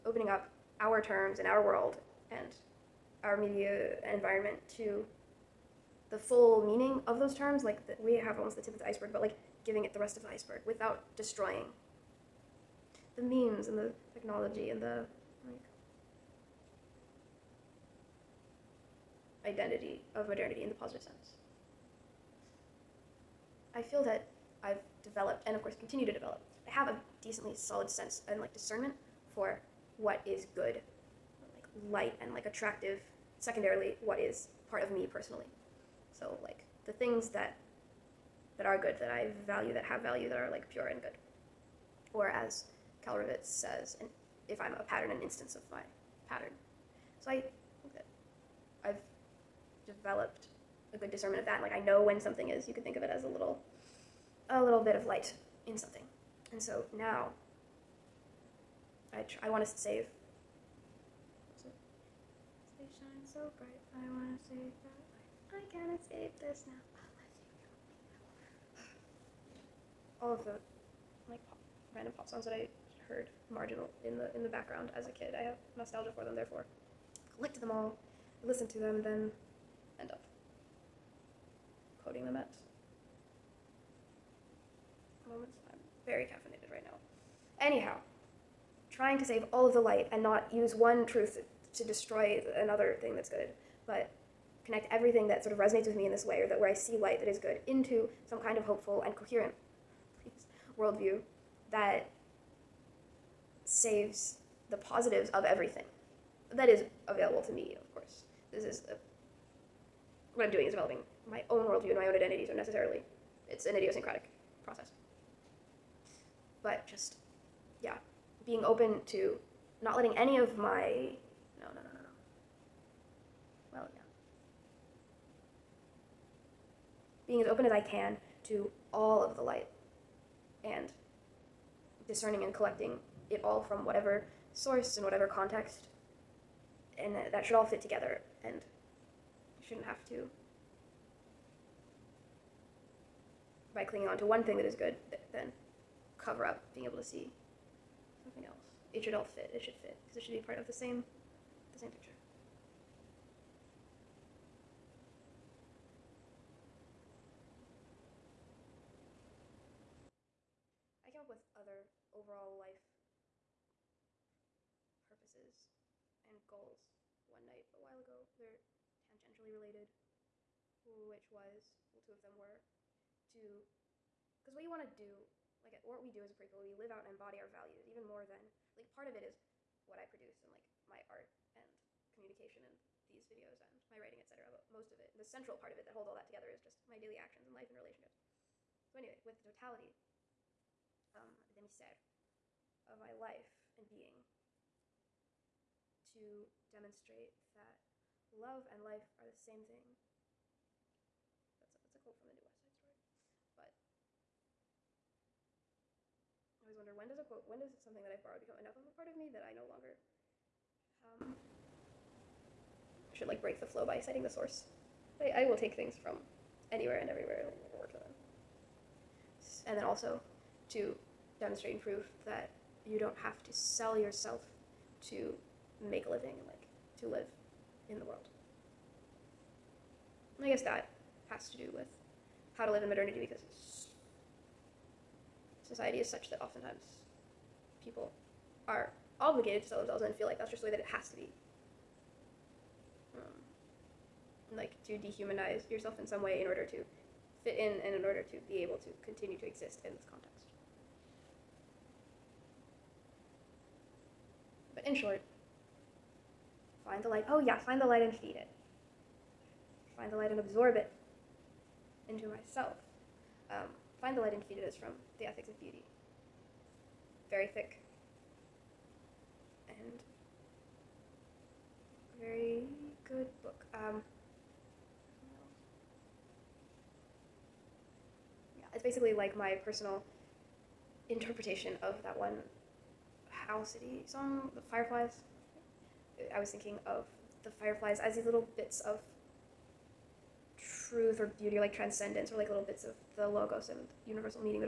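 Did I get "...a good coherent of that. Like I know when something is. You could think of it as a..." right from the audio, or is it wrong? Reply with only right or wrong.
wrong.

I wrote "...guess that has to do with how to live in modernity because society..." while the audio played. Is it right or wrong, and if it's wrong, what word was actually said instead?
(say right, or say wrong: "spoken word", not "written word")
right.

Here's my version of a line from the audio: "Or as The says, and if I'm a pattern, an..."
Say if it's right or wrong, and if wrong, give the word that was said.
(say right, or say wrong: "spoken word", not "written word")
wrong: "Kalrovitz", not "The".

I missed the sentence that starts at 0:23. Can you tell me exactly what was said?
I feel that I've developed and of course continue to develop.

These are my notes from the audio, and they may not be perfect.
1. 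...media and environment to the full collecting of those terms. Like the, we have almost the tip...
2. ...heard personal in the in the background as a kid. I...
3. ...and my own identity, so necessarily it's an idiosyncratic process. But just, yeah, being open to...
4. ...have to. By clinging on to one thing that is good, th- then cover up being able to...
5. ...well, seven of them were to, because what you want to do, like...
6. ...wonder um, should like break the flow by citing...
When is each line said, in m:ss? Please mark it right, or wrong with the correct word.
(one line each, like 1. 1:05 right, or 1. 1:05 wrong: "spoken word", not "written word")
1. 0:03 wrong: "meaning", not "collecting"
2. 1:13 wrong: "marginal", not "personal"
3. 1:51 right
4. 2:19 right
5. 2:51 wrong: "two", not "seven"
6. 3:29 wrong: "longer", not "wonder".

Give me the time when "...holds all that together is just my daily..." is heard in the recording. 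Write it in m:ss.
3:05.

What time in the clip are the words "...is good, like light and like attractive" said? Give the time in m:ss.
0:30.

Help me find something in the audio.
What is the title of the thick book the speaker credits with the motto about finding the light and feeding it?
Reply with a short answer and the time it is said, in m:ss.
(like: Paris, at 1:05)
The Ethics of Beauty, at 4:25.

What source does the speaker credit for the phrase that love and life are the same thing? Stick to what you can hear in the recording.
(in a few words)
the New West.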